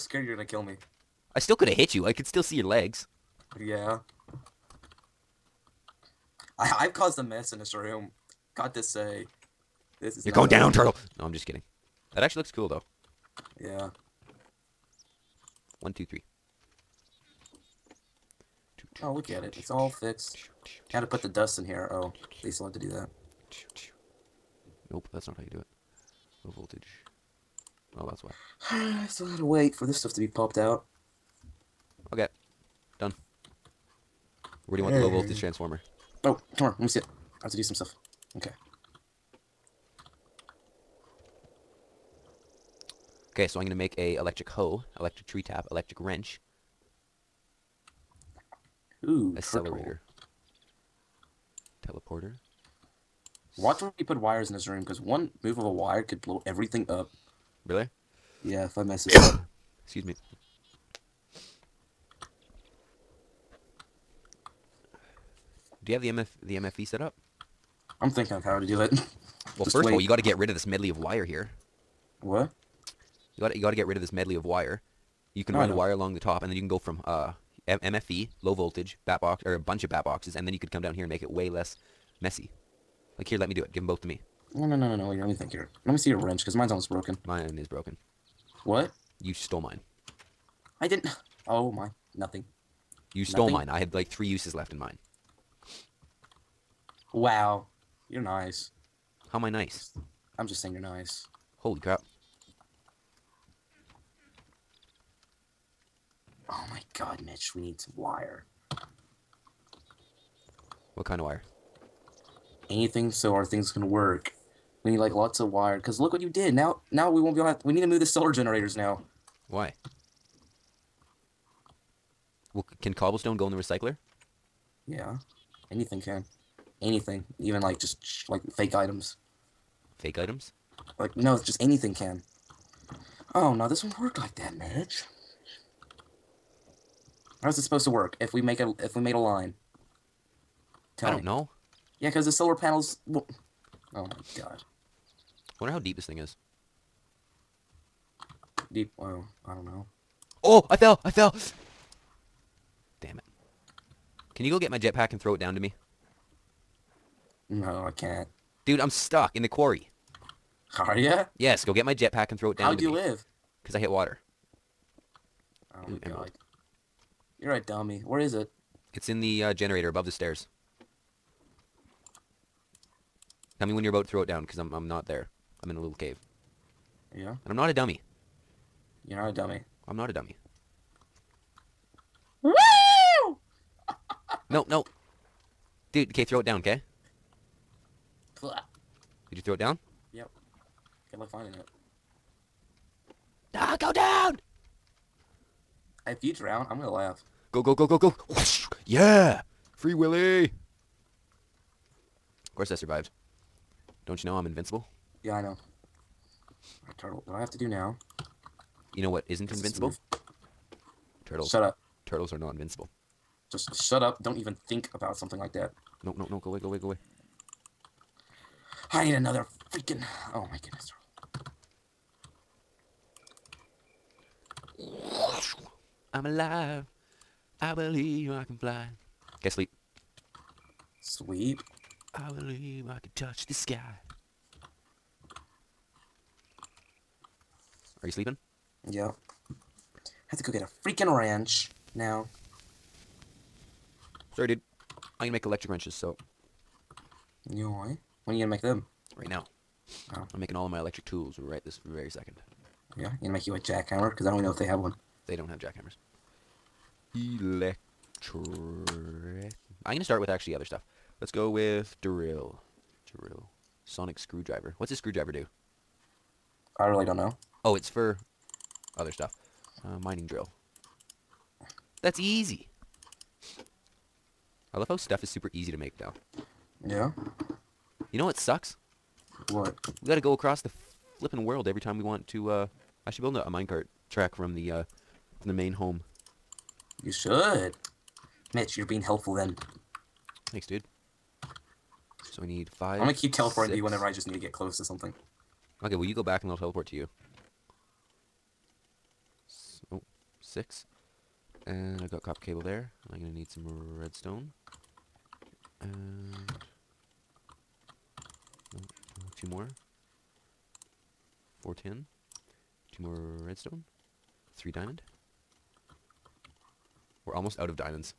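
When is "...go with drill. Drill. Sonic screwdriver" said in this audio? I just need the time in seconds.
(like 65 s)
261 s.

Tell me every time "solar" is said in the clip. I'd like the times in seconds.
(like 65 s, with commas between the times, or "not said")
118 s, 142 s.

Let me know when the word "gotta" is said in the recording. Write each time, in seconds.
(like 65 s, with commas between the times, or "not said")
29 s, 280 s.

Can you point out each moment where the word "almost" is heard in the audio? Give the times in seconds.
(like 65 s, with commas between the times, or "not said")
86 s, 317 s.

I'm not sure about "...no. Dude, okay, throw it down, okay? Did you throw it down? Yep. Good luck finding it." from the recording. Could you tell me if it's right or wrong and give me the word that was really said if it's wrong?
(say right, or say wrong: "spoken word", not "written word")
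right.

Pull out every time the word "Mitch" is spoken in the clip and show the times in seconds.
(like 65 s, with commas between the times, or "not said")
107 s, 134 s, 288 s.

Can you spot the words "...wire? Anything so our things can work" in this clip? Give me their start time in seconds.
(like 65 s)
111 s.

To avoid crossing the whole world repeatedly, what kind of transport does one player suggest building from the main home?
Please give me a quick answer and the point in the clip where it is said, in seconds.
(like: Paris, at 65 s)
minecart track, at 283 s.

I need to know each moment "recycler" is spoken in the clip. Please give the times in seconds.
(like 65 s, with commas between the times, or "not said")
123 s.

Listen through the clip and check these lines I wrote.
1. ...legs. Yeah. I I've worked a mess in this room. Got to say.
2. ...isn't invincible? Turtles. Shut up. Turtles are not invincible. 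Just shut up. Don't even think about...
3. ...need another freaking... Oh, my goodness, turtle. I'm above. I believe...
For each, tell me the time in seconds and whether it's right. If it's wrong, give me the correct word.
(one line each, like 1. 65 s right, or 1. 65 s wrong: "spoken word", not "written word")
1. 2 s wrong: "caused", not "worked"
2. 209 s right
3. 219 s wrong: "alive", not "above".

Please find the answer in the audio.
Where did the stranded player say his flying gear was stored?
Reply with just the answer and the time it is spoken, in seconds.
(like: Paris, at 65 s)
generator above the stairs, at 169 s.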